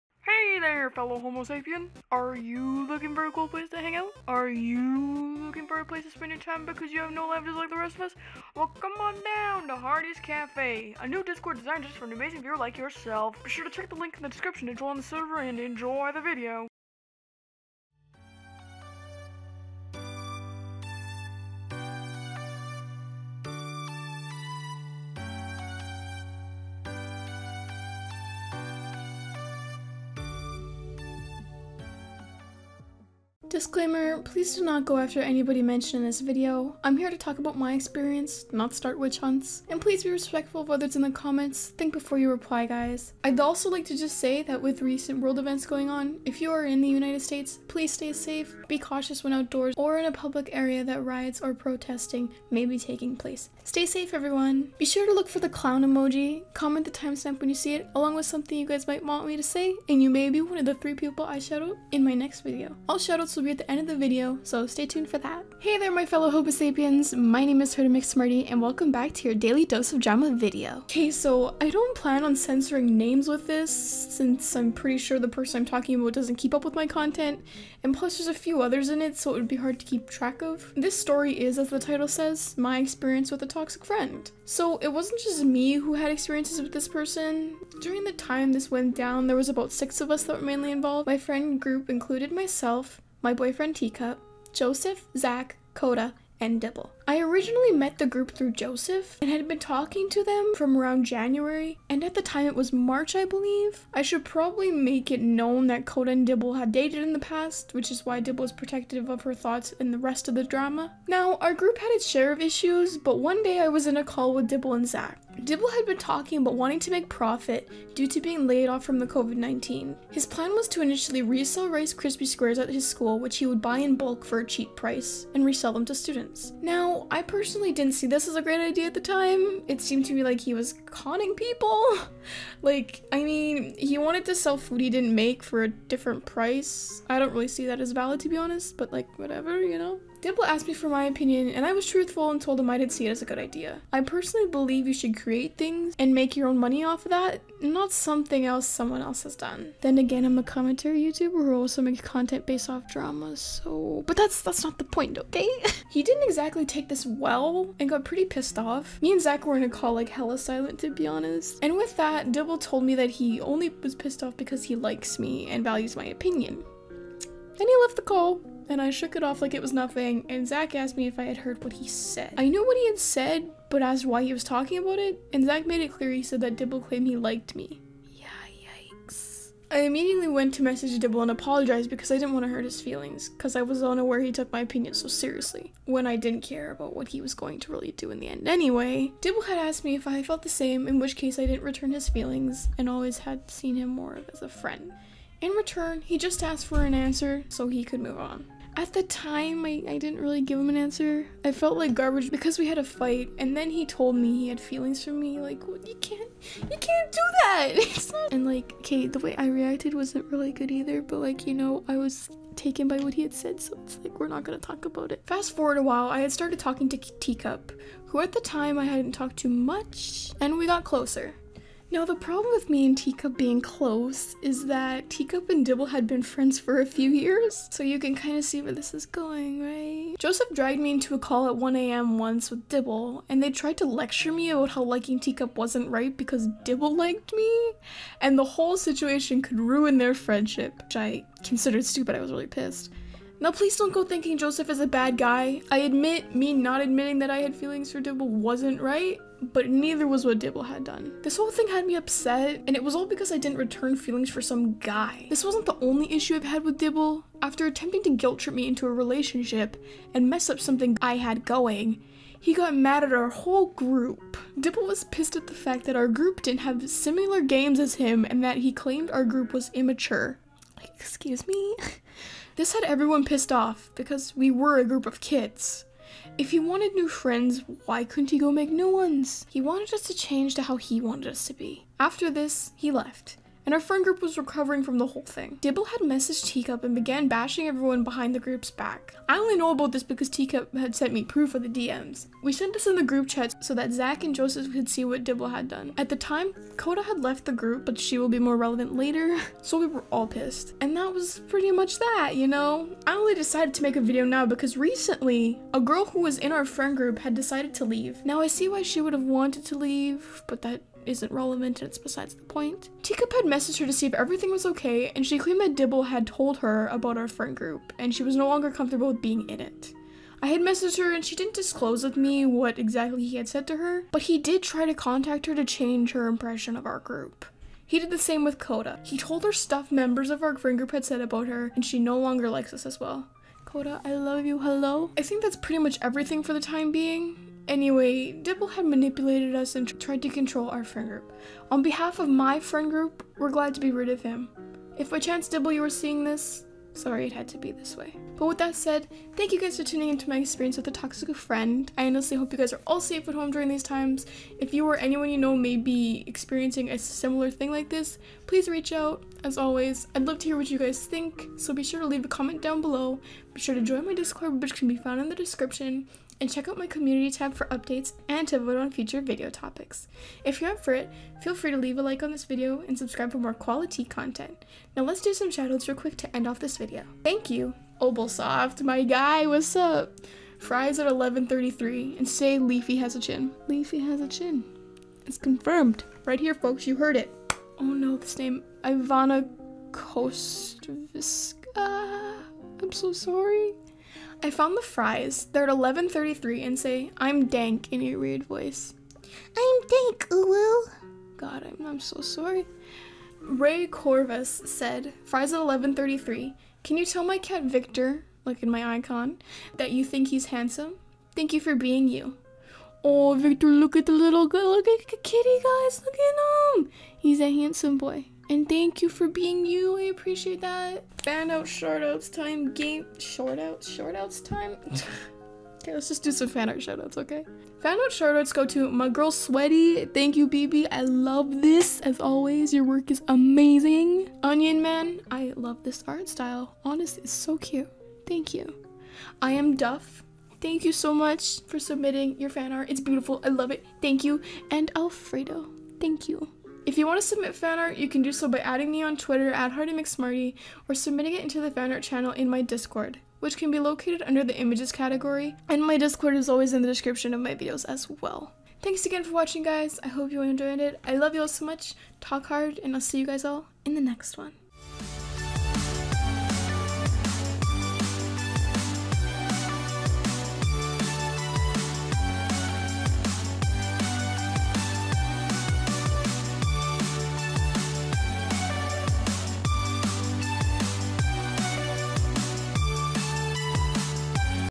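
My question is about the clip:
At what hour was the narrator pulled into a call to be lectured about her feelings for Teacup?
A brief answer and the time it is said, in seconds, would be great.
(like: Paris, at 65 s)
1am, at 231 s.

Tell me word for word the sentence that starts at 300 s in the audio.
And that was pretty much that, you know?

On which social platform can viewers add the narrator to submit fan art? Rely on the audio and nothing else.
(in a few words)
Twitter.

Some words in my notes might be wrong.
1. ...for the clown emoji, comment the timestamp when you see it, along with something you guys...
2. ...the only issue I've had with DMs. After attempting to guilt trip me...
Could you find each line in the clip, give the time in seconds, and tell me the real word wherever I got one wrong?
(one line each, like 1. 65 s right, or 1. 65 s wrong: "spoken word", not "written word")
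1. 55 s right
2. 255 s wrong: "Dibble", not "DMs".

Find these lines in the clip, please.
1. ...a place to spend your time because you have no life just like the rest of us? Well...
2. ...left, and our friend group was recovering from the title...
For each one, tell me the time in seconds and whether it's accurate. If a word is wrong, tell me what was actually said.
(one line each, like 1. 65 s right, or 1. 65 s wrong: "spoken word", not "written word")
1. 5 s right
2. 282 s wrong: "whole", not "title".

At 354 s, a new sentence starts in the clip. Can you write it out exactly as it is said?
If you or anyone you know may be experiencing a similar thing like this, please reach out.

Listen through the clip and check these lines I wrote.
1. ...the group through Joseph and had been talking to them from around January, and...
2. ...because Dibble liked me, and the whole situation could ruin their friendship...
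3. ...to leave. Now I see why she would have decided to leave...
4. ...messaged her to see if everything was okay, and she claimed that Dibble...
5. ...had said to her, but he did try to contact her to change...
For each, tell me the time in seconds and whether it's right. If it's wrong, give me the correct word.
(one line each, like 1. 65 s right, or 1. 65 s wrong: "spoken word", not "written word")
1. 97 s right
2. 236 s right
3. 307 s wrong: "wanted", not "decided"
4. 313 s right
5. 323 s right.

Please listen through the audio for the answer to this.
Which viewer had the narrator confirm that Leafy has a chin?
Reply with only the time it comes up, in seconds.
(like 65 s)
377 s.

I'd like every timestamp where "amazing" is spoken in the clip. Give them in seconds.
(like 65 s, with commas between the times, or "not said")
12 s, 433 s.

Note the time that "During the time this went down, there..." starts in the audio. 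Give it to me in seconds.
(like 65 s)
87 s.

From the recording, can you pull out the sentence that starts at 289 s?
I only know about this because Teacup had sent me proof of the DMs.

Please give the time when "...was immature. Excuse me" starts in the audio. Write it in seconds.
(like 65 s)
269 s.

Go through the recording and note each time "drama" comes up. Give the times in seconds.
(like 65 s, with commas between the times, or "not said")
69 s, 110 s, 152 s.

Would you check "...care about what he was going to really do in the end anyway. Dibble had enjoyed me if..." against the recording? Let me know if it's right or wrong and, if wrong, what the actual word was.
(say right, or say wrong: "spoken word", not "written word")
wrong: "asked", not "enjoyed".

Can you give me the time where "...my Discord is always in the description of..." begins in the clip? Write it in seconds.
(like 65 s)
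455 s.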